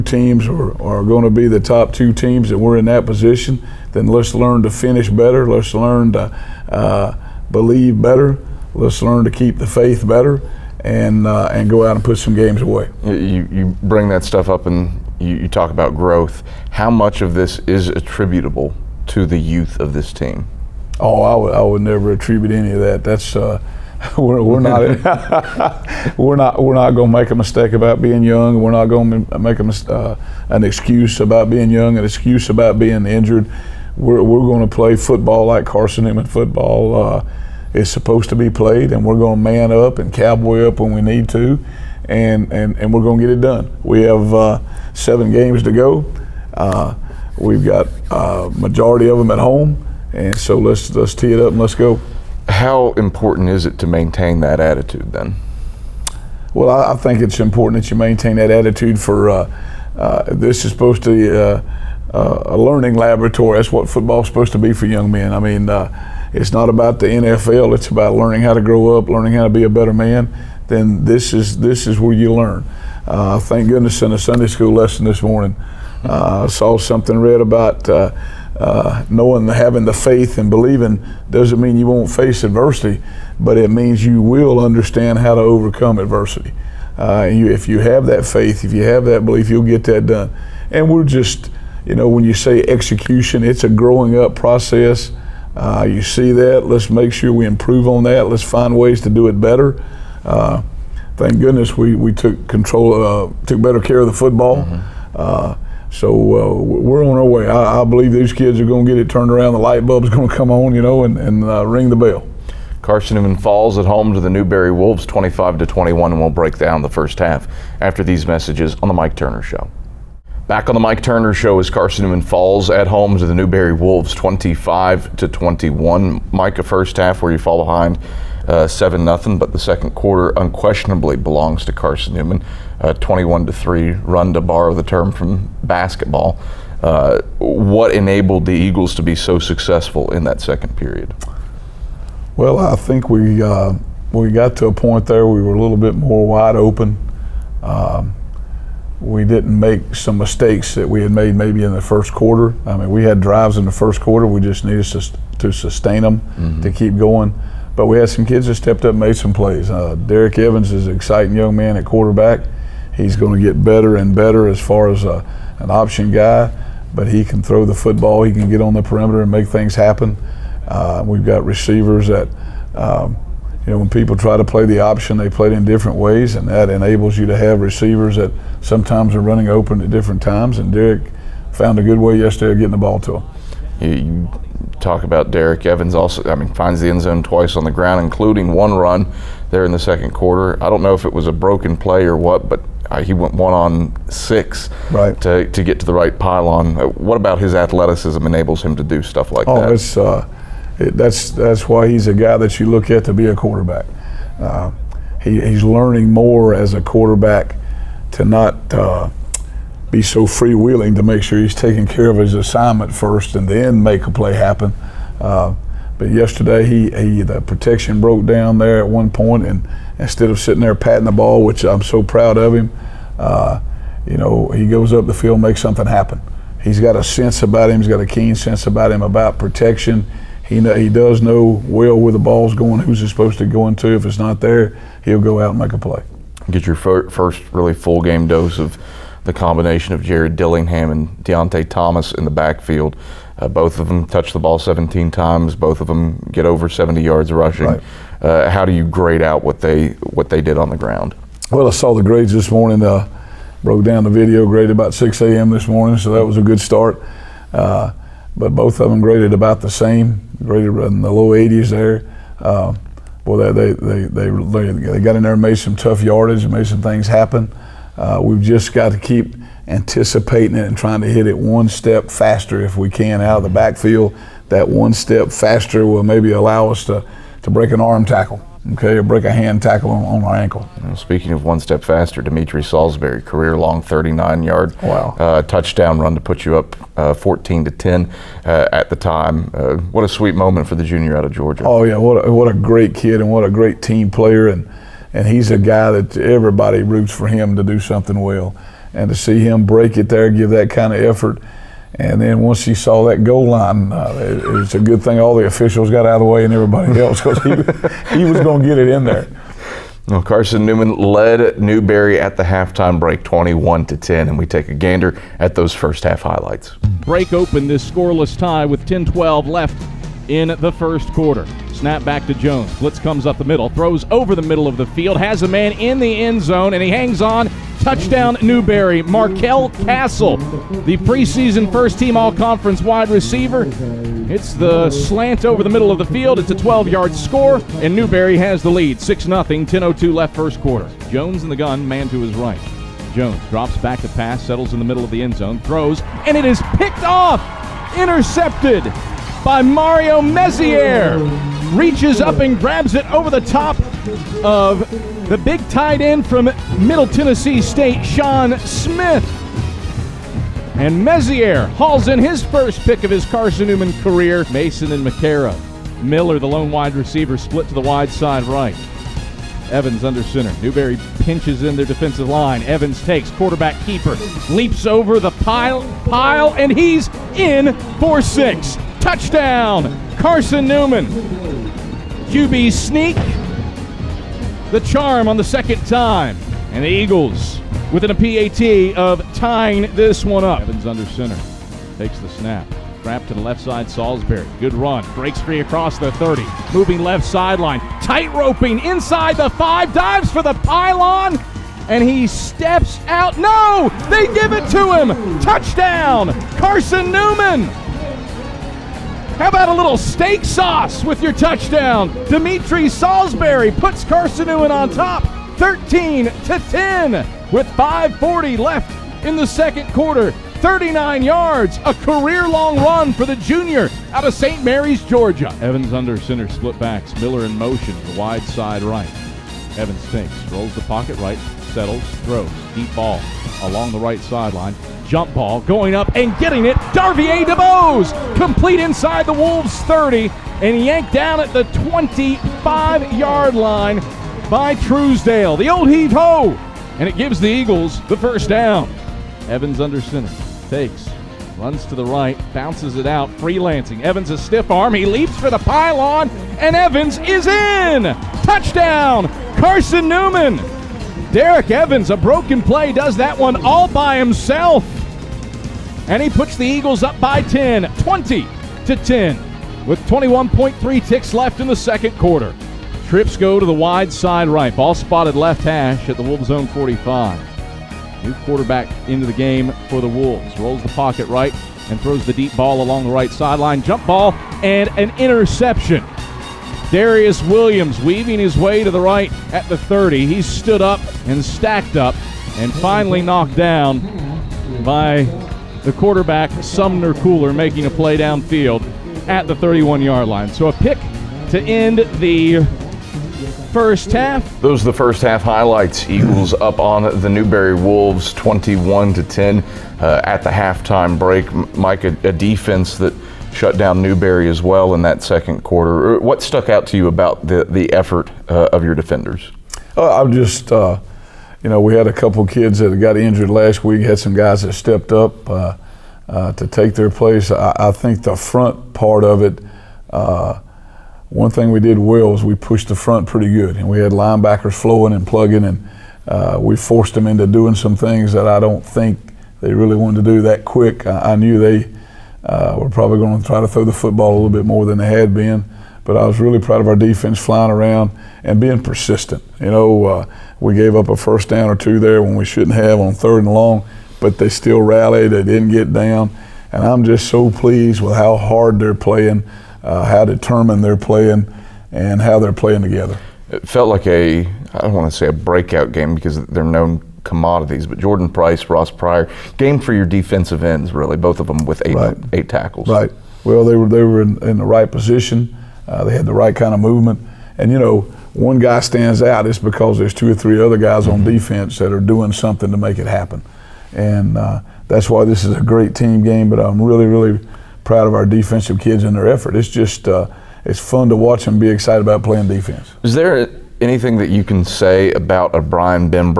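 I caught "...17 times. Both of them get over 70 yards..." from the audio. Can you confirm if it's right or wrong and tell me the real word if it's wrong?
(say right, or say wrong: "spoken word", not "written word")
right.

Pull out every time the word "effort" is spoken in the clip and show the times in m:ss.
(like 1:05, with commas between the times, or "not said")
5:01, 8:37, 9:49.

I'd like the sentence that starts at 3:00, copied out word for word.
And Derek found a good way yesterday of getting the ball to him.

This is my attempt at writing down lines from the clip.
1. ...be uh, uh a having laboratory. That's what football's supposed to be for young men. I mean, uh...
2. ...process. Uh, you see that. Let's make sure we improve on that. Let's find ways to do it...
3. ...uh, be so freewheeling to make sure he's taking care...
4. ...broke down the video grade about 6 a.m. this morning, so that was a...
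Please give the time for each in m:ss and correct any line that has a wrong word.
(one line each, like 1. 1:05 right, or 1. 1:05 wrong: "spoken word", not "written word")
1. 1:01 wrong: "learning", not "having"
2. 1:34 right
3. 3:28 right
4. 4:13 right.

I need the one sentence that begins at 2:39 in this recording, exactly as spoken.
Uh, Derek Evans is an exciting young man at quarterback.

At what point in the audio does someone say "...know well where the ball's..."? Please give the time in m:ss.
3:51.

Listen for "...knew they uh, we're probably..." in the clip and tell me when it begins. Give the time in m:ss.
9:01.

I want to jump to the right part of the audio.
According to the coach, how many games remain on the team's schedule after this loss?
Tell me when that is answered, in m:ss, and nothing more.
0:44.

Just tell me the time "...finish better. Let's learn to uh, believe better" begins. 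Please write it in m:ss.
0:04.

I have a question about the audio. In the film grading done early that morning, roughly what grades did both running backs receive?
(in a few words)
low 80s.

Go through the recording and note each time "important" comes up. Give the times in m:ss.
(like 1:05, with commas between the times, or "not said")
0:52, 0:57.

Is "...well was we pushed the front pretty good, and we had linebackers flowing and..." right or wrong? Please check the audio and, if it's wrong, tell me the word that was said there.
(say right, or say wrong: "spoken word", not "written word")
right.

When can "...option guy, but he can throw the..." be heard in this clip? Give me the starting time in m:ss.
2:45.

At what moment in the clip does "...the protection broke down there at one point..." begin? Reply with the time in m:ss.
3:37.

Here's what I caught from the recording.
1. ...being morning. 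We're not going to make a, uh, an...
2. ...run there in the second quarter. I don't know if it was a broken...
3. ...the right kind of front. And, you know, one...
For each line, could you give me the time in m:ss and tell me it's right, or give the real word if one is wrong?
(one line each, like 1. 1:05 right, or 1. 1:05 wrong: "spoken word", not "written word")
1. 0:28 wrong: "young", not "morning"
2. 3:08 right
3. 9:36 wrong: "movement", not "front".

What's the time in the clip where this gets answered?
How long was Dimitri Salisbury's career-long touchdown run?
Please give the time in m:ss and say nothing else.
4:43.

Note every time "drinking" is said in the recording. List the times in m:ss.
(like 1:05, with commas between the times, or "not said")
not said.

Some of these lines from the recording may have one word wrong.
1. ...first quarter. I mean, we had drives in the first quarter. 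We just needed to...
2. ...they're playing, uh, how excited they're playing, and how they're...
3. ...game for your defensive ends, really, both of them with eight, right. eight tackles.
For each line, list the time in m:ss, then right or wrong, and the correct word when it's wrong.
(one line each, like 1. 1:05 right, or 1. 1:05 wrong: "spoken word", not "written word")
1. 2:31 right
2. 9:18 wrong: "determined", not "excited"
3. 9:29 right.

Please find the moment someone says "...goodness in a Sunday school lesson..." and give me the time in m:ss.
1:13.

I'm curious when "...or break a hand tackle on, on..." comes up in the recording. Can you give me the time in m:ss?
4:38.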